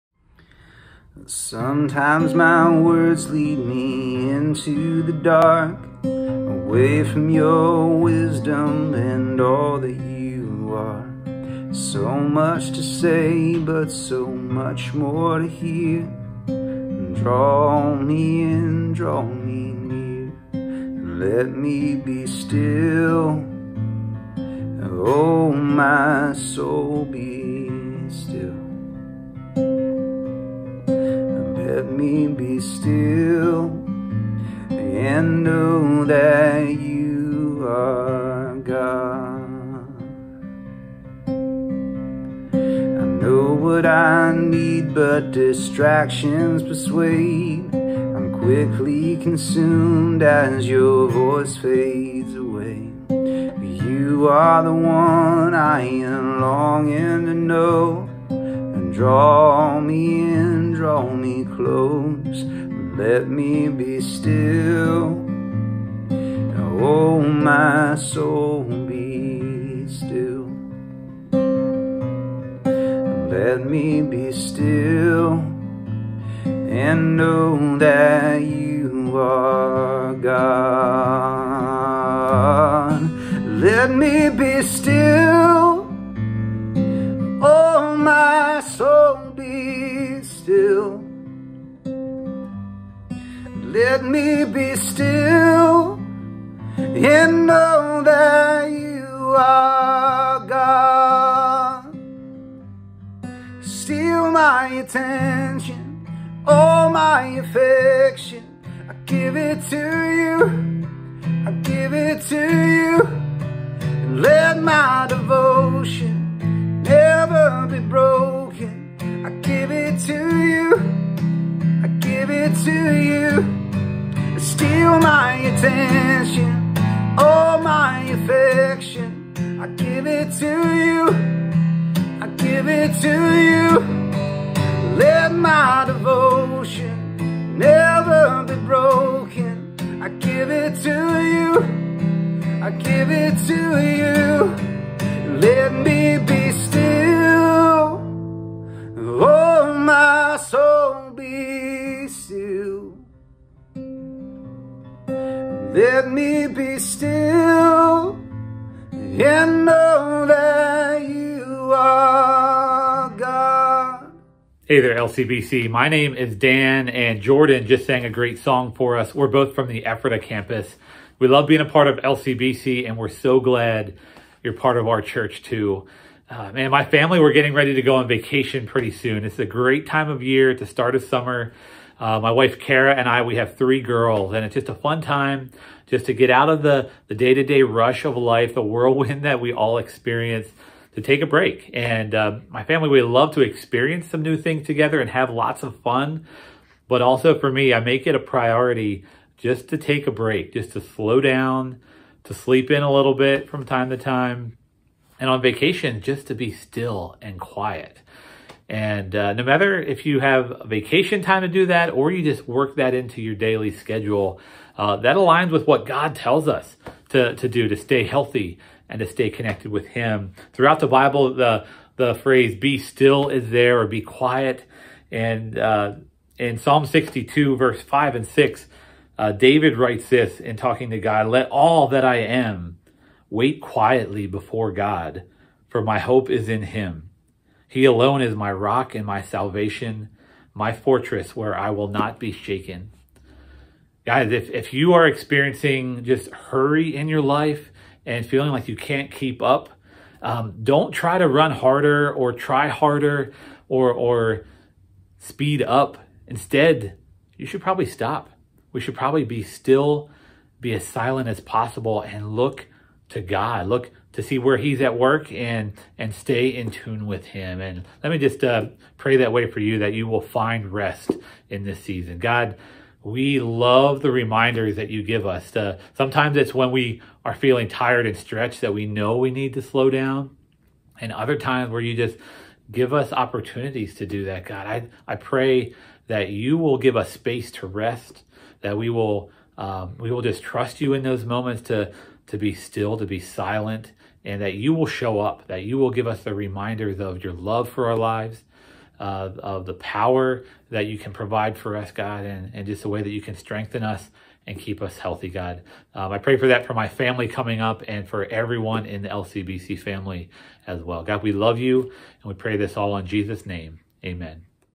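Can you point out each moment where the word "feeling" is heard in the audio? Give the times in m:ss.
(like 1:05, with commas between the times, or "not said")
4:08, 4:37.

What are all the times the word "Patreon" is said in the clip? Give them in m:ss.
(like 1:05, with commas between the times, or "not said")
not said.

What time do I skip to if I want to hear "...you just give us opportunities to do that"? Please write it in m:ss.
4:41.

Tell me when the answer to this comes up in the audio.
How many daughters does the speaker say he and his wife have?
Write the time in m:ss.
3:03.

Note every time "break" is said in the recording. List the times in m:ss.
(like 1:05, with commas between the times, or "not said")
3:11, 3:20.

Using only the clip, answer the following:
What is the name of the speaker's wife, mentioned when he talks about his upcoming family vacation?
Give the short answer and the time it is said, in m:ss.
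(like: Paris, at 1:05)
Kara, at 3:02.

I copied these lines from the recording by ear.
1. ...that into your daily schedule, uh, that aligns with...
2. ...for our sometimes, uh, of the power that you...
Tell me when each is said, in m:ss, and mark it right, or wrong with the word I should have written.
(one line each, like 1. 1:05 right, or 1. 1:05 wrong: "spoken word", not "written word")
1. 3:32 right
2. 4:57 wrong: "lives", not "sometimes".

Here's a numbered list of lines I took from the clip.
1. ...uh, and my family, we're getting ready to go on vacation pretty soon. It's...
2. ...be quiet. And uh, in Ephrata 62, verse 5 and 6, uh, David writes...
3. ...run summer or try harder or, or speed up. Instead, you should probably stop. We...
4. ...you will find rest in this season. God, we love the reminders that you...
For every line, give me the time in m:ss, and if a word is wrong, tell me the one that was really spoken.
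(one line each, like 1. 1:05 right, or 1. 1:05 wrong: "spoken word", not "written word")
1. 2:56 right
2. 3:43 wrong: "Psalm", not "Ephrata"
3. 4:11 wrong: "harder", not "summer"
4. 4:29 right.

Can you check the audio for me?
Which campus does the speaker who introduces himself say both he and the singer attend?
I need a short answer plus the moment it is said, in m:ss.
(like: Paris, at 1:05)
Ephrata, at 2:49.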